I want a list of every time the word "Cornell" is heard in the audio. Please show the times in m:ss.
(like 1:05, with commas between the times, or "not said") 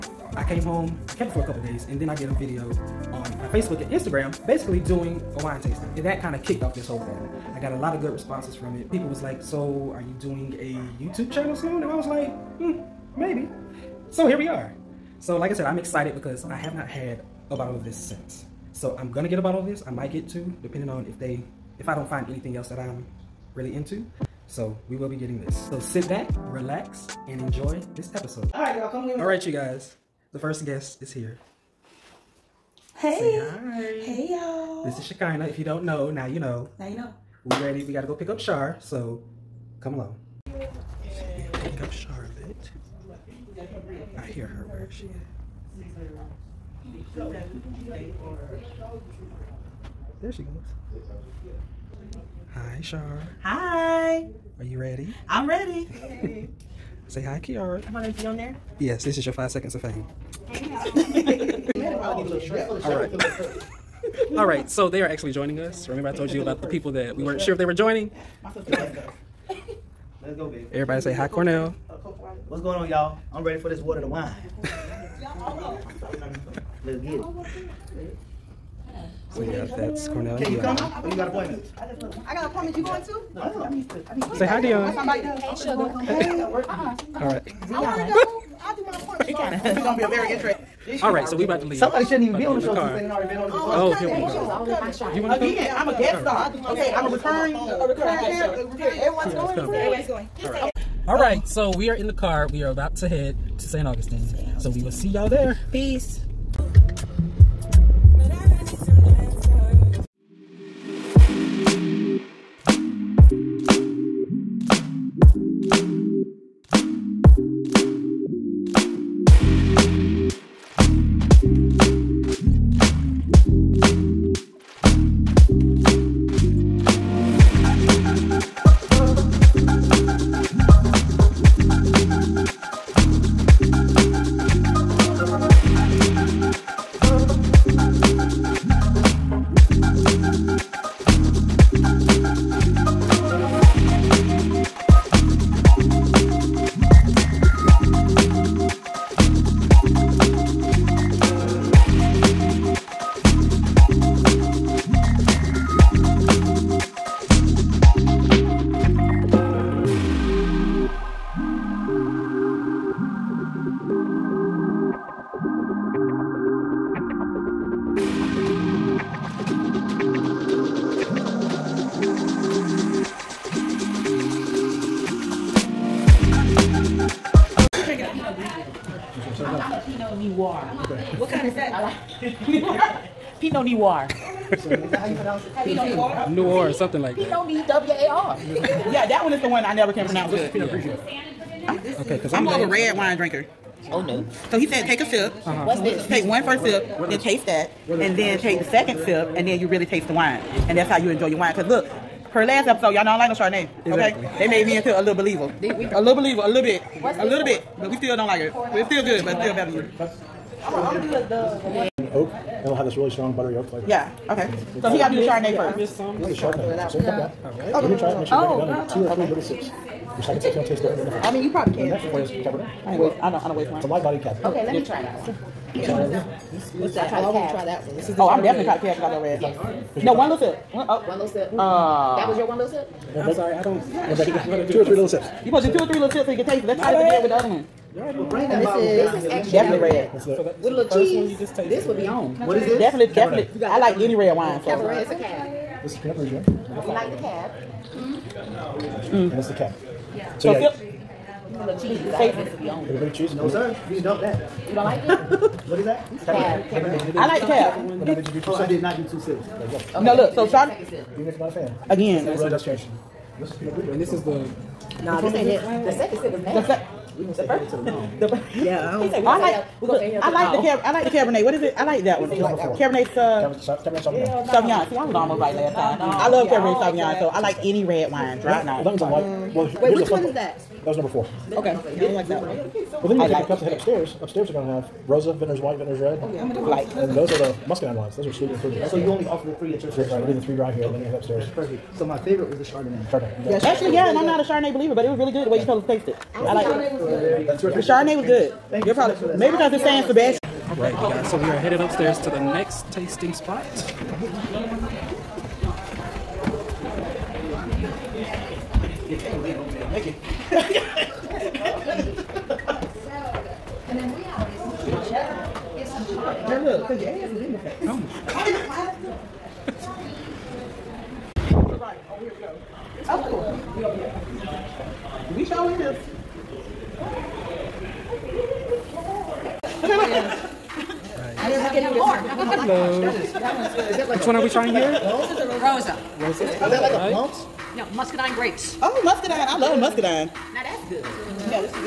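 1:11, 1:20.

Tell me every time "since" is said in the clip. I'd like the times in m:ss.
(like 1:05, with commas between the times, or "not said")
0:17, 1:32.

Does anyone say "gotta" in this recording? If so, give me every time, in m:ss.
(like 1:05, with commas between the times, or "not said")
0:37.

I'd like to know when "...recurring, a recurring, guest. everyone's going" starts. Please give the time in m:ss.
1:37.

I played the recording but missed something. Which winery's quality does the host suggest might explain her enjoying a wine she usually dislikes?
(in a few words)
San Sebastian.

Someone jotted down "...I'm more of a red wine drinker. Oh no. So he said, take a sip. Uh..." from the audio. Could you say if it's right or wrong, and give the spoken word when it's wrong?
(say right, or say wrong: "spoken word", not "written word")
right.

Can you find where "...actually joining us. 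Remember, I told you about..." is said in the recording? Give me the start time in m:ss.
1:05.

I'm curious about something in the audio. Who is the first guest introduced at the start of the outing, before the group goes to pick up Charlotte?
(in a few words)
Shekinah.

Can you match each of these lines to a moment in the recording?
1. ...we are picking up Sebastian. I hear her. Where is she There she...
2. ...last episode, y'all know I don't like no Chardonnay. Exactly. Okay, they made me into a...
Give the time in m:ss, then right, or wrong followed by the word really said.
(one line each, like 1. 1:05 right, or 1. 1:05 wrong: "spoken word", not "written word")
1. 0:41 wrong: "Charlotte", not "Sebastian"
2. 3:22 right.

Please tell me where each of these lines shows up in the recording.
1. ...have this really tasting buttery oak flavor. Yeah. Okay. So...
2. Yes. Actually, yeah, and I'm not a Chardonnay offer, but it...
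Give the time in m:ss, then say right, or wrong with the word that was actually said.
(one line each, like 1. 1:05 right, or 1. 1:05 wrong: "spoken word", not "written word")
1. 3:32 wrong: "strong", not "tasting"
2. 4:53 wrong: "believer", not "offer".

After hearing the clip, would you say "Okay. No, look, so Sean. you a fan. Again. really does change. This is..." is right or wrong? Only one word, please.
right.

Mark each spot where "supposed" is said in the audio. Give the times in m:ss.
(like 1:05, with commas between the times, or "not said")
3:55.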